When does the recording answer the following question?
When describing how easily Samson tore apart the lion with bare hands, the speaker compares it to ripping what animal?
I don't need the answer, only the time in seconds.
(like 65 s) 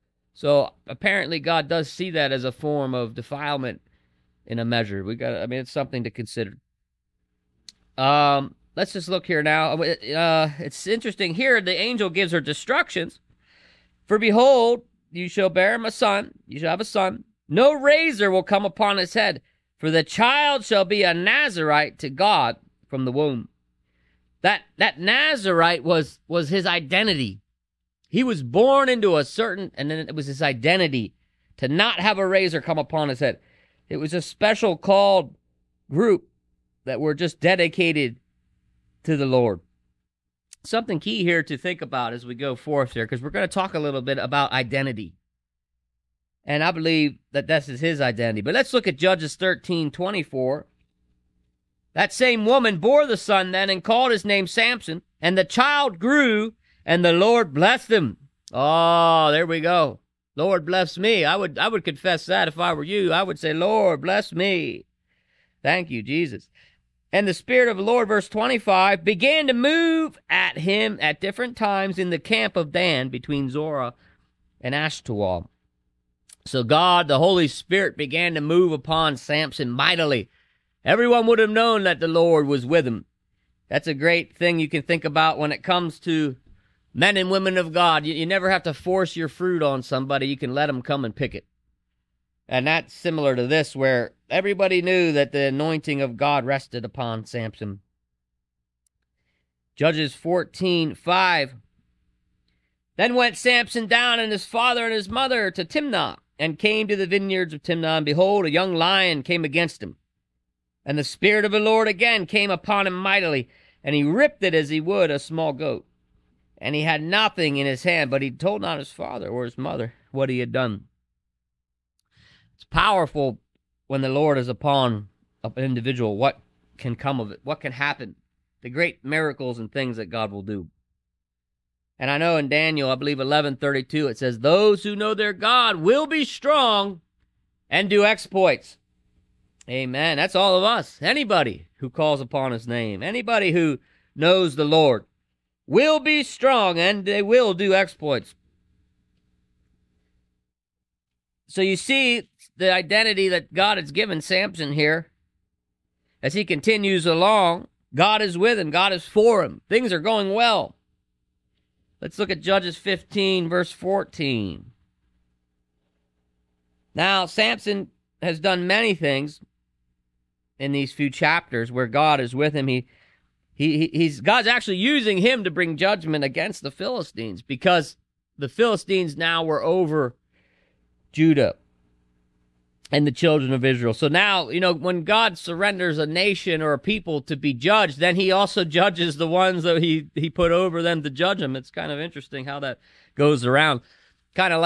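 115 s.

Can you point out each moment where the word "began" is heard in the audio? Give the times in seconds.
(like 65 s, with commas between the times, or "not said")
69 s, 77 s.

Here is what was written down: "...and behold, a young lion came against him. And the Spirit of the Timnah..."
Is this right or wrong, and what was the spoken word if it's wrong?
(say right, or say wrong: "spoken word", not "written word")
wrong: "Lord", not "Timnah".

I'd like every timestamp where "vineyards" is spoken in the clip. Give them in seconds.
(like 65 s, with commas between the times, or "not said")
107 s.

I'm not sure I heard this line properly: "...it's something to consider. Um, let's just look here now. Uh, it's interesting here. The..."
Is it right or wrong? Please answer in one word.
right.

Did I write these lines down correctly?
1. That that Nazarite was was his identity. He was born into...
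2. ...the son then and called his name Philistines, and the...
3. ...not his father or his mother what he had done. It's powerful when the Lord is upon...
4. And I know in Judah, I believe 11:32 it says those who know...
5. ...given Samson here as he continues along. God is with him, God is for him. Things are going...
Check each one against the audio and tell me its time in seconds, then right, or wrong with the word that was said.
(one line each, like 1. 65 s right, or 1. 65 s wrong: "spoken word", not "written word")
1. 24 s right
2. 53 s wrong: "Samson", not "Philistines"
3. 118 s right
4. 131 s wrong: "Daniel", not "Judah"
5. 153 s right.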